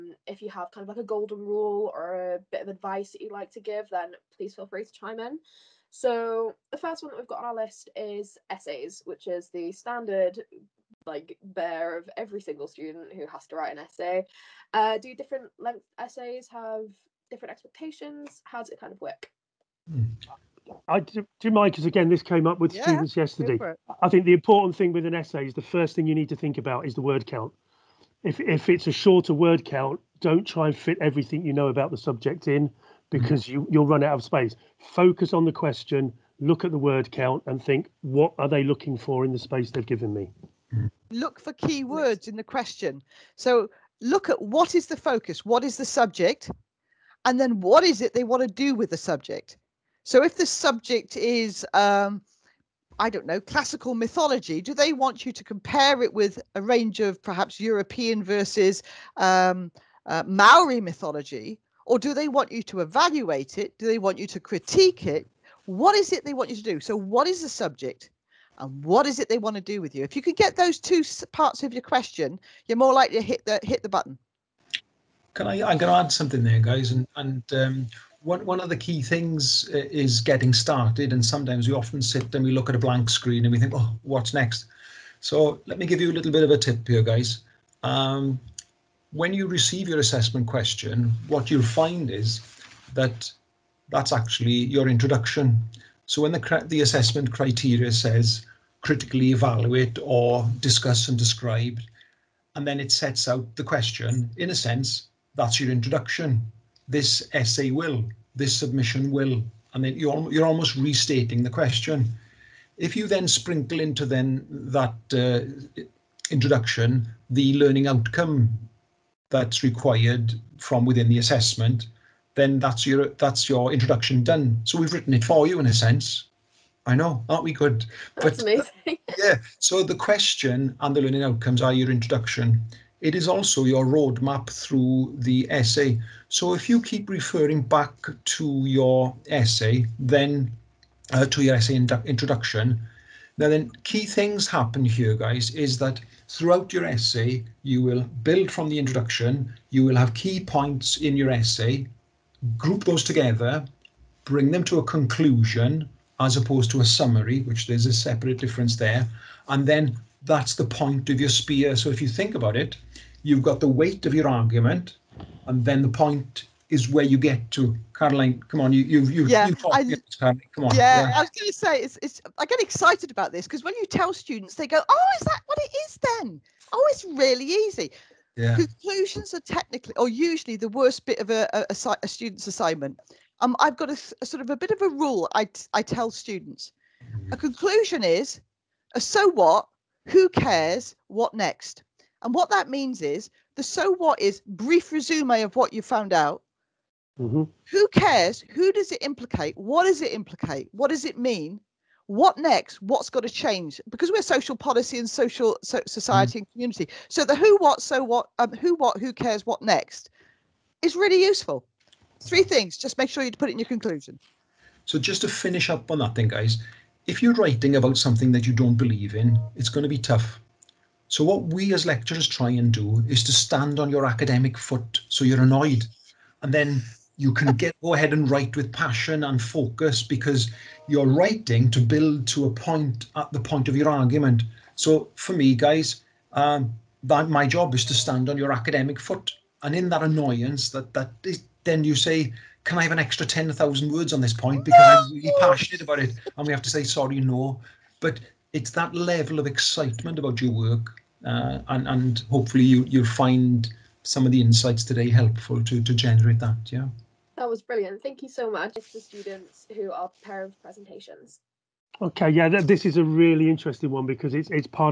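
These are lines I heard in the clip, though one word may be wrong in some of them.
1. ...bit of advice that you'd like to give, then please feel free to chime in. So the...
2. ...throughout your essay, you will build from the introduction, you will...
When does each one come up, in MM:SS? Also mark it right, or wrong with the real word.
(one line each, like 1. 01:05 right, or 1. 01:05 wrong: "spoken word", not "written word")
1. 00:02 right
2. 02:26 right.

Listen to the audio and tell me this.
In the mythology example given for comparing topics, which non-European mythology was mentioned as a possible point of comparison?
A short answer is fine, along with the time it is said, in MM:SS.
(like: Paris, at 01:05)
Maori mythology, at 01:00.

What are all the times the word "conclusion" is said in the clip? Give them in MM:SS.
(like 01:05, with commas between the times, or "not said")
02:34, 02:58, 03:07, 03:33.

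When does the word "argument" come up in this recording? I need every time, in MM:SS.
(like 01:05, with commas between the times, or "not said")
02:44, 03:53.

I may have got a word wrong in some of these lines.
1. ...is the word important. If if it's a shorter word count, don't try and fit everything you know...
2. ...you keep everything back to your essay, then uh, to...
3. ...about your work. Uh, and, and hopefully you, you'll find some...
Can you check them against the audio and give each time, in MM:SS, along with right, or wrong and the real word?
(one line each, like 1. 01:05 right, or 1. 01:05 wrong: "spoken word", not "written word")
1. 00:26 wrong: "count", not "important"
2. 02:16 wrong: "referring", not "everything"
3. 04:10 right.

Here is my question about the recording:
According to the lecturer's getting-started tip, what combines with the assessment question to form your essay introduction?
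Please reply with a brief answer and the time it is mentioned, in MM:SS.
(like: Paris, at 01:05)
The learning outcomes, at 02:10.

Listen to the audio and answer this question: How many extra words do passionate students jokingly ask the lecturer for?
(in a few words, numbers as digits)
10,000.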